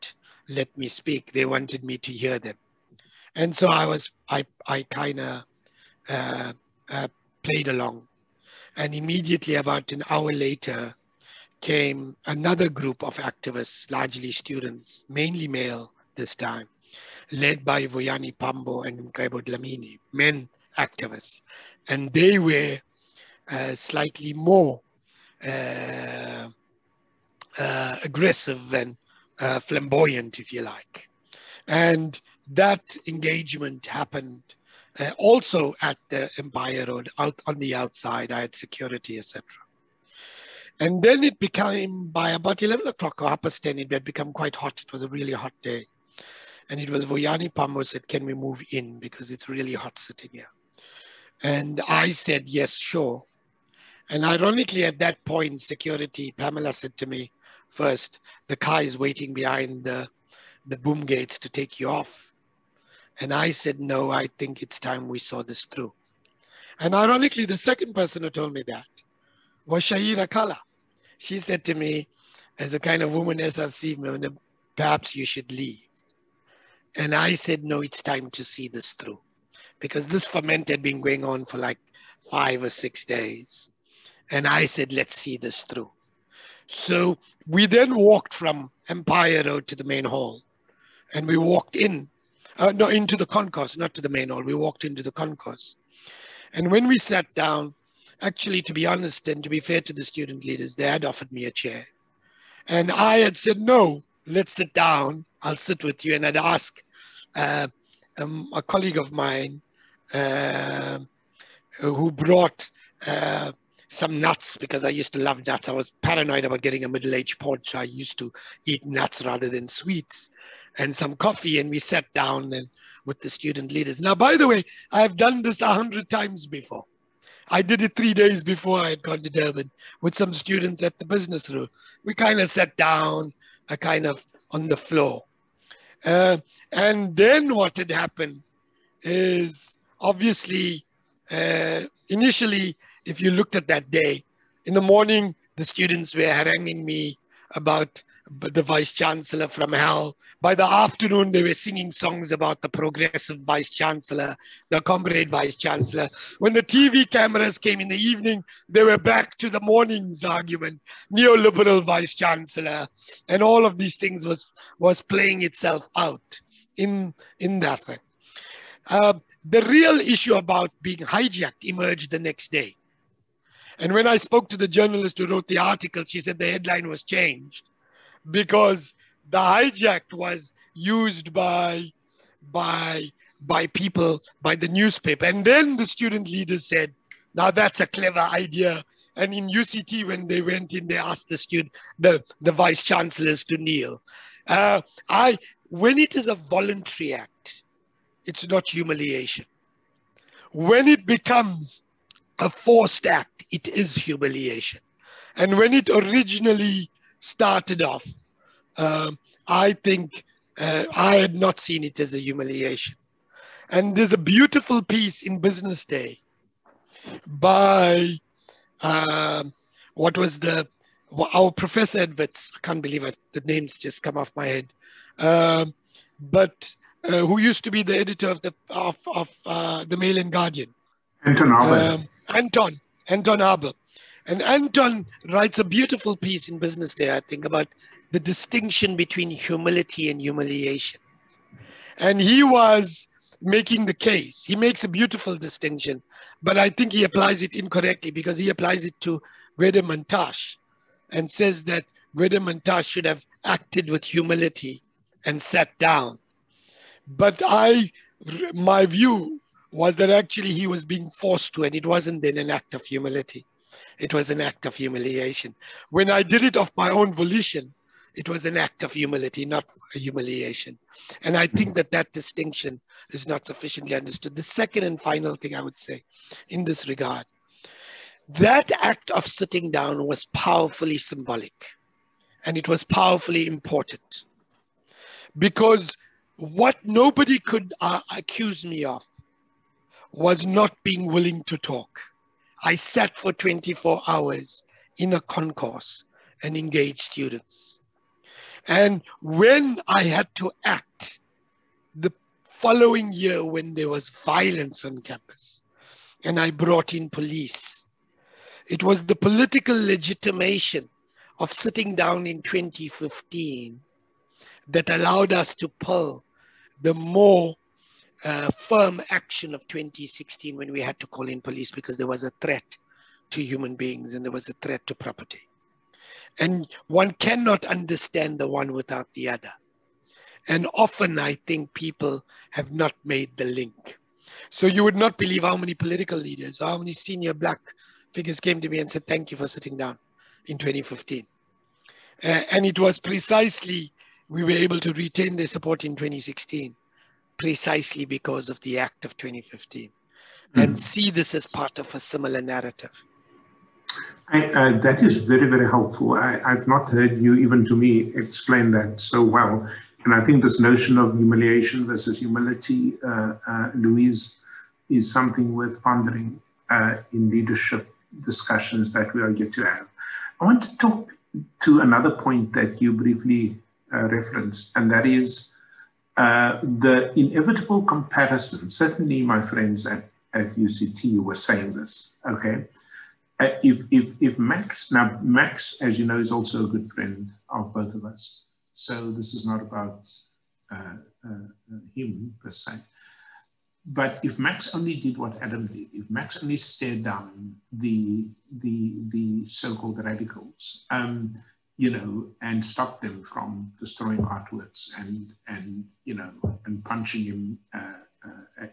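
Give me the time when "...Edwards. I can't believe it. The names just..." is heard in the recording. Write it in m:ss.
3:41.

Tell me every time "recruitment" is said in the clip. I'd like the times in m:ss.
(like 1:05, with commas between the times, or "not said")
not said.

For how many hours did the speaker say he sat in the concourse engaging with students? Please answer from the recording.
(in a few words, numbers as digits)
24.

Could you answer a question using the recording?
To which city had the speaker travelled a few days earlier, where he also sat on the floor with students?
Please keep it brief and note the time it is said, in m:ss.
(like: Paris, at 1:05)
Durban, at 2:09.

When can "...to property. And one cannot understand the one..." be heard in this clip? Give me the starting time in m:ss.
5:24.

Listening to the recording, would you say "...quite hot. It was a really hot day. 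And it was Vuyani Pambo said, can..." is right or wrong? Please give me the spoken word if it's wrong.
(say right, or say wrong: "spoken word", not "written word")
right.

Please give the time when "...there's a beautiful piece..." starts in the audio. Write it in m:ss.
3:33.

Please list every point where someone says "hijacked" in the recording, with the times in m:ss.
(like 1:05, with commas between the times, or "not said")
2:50, 2:59.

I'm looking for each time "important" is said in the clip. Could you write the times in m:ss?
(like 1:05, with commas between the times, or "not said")
4:43.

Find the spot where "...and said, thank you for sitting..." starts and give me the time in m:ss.
5:38.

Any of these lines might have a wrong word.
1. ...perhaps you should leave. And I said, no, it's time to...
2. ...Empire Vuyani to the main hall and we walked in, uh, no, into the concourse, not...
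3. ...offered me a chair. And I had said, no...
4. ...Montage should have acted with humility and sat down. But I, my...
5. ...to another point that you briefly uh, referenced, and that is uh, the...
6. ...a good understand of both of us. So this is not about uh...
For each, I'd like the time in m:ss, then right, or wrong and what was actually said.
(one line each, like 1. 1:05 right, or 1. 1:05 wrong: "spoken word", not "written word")
1. 1:14 right
2. 1:28 wrong: "Road", not "Vuyani"
3. 1:41 right
4. 4:12 right
5. 6:11 right
6. 6:26 wrong: "friend", not "understand".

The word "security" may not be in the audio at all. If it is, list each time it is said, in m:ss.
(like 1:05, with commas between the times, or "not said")
0:38, 0:55.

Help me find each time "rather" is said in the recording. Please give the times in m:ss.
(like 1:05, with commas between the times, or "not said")
1:59.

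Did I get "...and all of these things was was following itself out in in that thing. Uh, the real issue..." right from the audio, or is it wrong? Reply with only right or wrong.
wrong.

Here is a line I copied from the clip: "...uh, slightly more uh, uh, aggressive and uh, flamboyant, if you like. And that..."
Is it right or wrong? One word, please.
right.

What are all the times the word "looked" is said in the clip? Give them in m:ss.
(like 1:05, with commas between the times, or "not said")
2:23.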